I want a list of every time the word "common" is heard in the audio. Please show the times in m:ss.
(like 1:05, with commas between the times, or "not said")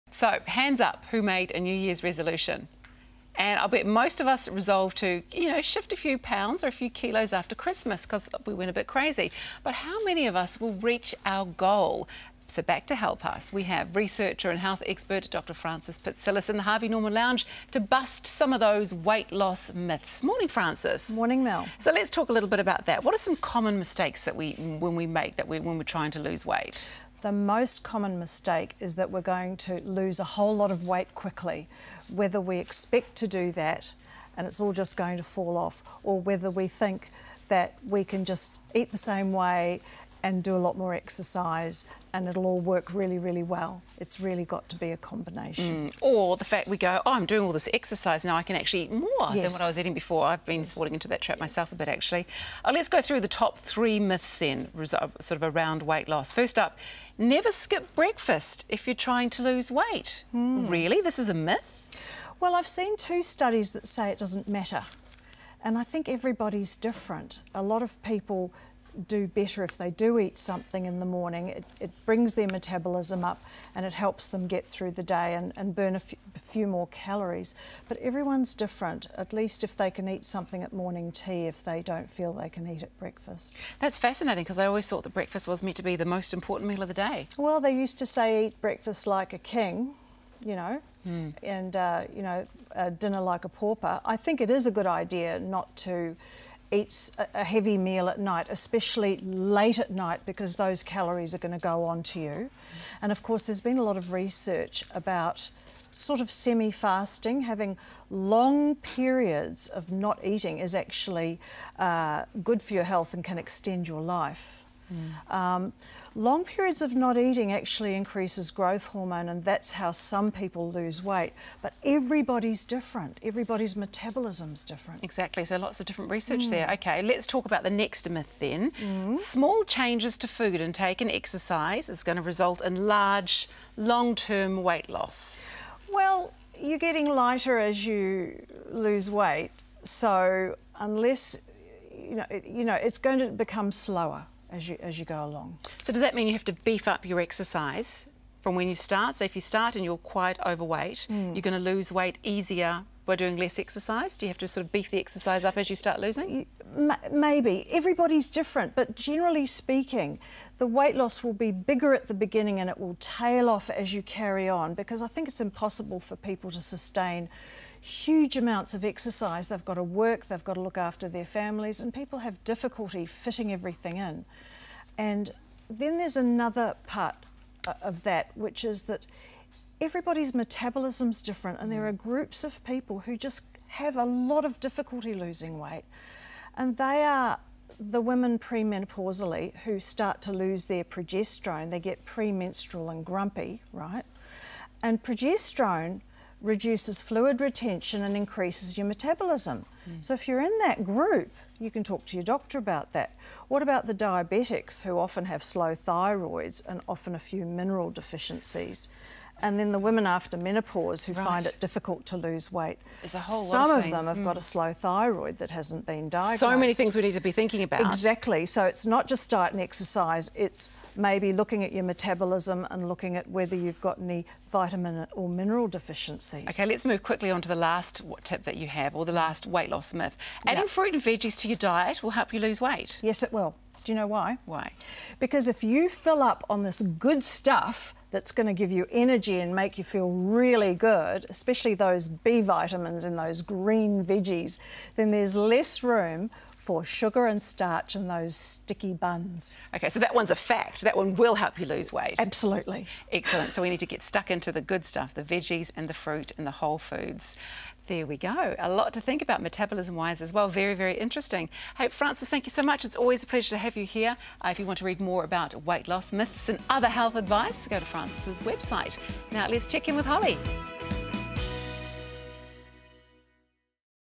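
0:23, 0:27.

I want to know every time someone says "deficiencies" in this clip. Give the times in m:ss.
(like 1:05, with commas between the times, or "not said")
3:27, 3:45.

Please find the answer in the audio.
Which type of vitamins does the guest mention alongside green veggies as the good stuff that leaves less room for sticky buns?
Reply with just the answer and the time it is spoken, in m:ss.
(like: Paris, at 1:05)
B vitamins, at 4:02.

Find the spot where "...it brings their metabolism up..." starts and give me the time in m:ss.
1:11.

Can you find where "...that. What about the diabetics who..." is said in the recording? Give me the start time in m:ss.
3:22.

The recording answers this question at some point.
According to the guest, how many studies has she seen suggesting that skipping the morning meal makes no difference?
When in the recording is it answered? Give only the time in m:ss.
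1:02.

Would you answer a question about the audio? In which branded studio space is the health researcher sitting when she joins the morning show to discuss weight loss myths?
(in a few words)
Harvey Norman Lounge.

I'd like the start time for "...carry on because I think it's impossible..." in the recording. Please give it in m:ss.
2:44.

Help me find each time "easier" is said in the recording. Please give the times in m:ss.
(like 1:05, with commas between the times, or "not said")
2:32.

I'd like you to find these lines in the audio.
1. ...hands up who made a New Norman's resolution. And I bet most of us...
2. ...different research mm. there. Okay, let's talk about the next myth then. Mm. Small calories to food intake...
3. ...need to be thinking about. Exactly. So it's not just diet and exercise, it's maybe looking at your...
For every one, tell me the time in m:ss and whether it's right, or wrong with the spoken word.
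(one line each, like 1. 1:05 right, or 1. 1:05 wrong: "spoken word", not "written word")
1. 0:00 wrong: "Year", not "Norman"
2. 2:05 wrong: "changes", not "calories"
3. 3:37 right.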